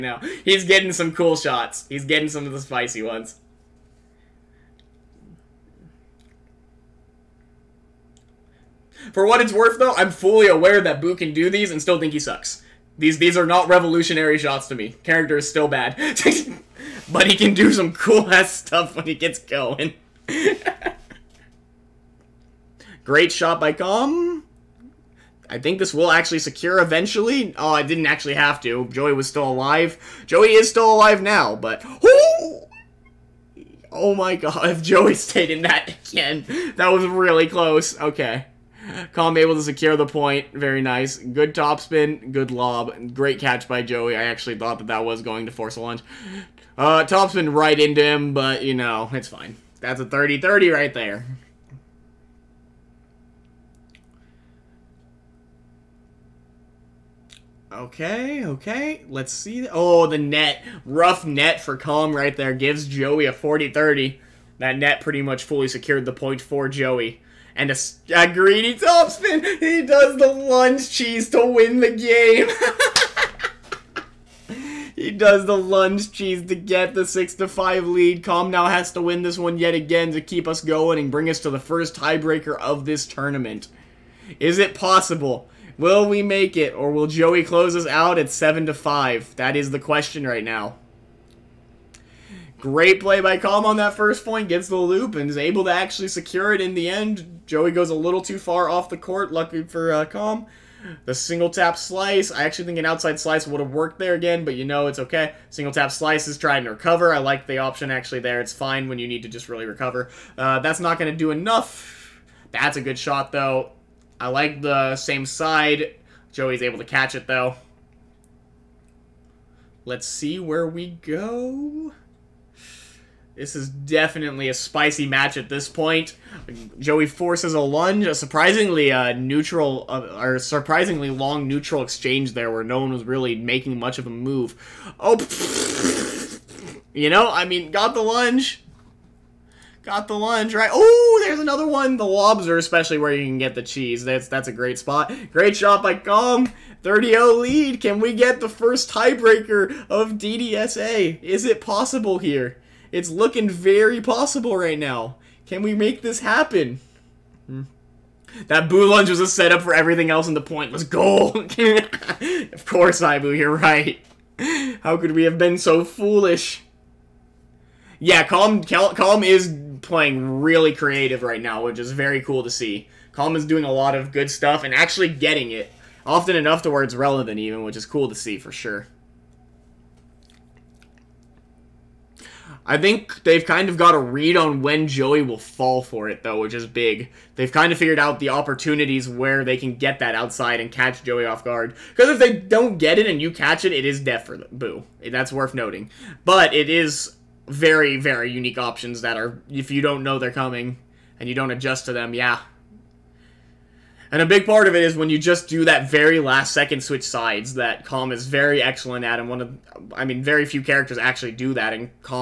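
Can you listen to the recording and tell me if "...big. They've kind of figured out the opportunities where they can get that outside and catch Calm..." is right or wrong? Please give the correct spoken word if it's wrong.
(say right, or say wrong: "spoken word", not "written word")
wrong: "Joey", not "Calm".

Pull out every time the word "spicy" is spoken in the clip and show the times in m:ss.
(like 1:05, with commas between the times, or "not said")
0:02, 2:04.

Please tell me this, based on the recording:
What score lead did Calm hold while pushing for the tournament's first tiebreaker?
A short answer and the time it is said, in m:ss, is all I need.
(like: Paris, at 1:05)
30-0, at 2:26.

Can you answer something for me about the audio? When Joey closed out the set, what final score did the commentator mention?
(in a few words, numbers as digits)
7 to 5.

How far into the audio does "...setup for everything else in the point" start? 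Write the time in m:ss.
2:39.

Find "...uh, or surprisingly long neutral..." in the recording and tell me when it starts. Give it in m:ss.
2:09.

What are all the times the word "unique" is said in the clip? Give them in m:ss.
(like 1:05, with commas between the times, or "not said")
3:18.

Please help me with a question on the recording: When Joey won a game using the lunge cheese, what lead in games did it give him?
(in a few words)
6-5.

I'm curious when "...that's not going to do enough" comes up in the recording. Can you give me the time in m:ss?
1:50.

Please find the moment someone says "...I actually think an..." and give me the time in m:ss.
1:42.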